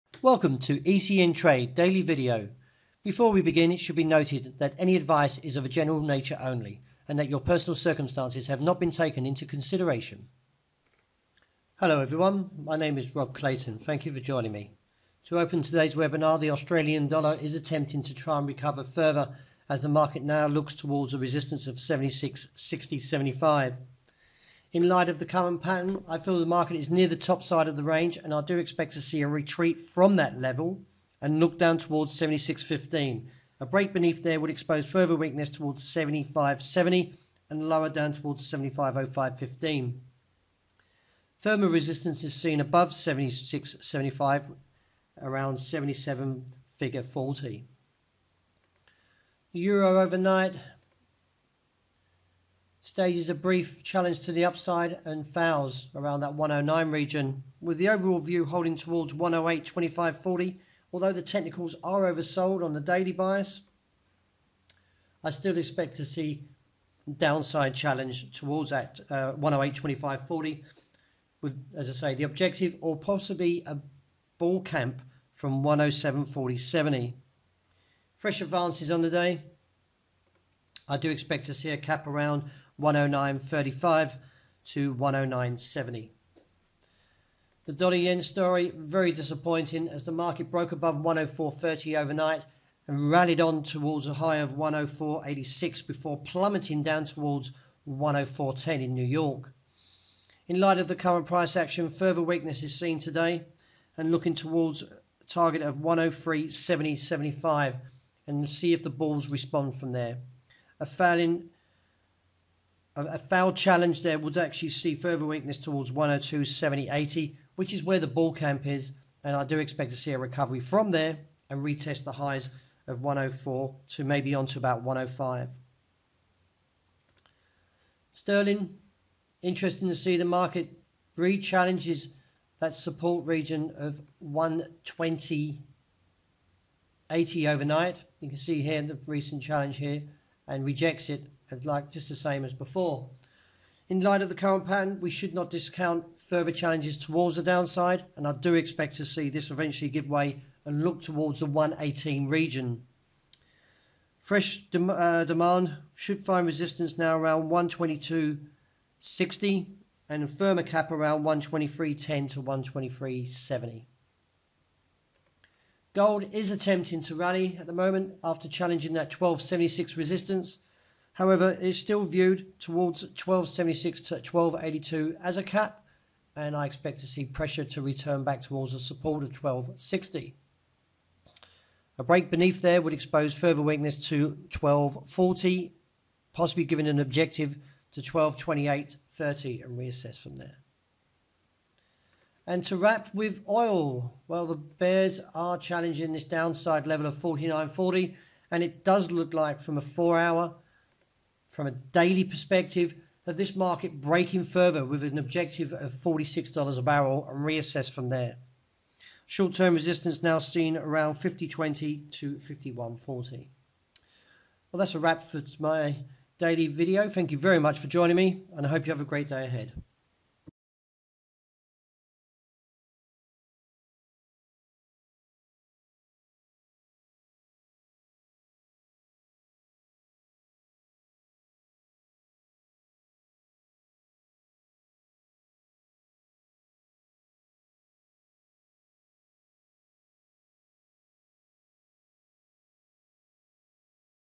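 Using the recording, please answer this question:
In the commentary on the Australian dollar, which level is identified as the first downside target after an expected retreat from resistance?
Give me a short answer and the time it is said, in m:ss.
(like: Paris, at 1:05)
76.15, at 0:32.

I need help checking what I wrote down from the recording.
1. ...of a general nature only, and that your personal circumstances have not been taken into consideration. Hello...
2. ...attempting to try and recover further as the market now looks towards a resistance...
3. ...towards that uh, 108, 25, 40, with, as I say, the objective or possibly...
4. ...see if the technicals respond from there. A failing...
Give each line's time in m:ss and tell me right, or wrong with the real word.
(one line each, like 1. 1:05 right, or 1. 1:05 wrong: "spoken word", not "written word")
1. 0:05 right
2. 0:17 right
3. 1:08 right
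4. 1:48 wrong: "bulls", not "technicals".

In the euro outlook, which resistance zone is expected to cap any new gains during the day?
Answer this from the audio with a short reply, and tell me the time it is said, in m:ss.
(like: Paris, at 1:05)
109.35 to 109.70, at 1:22.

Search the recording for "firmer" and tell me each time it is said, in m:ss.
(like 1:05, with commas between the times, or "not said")
2:40.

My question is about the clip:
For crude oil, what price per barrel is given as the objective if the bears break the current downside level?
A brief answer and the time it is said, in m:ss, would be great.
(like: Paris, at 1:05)
$46, at 3:25.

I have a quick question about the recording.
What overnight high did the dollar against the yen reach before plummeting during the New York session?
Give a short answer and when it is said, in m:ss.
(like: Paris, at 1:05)
104.86, at 1:34.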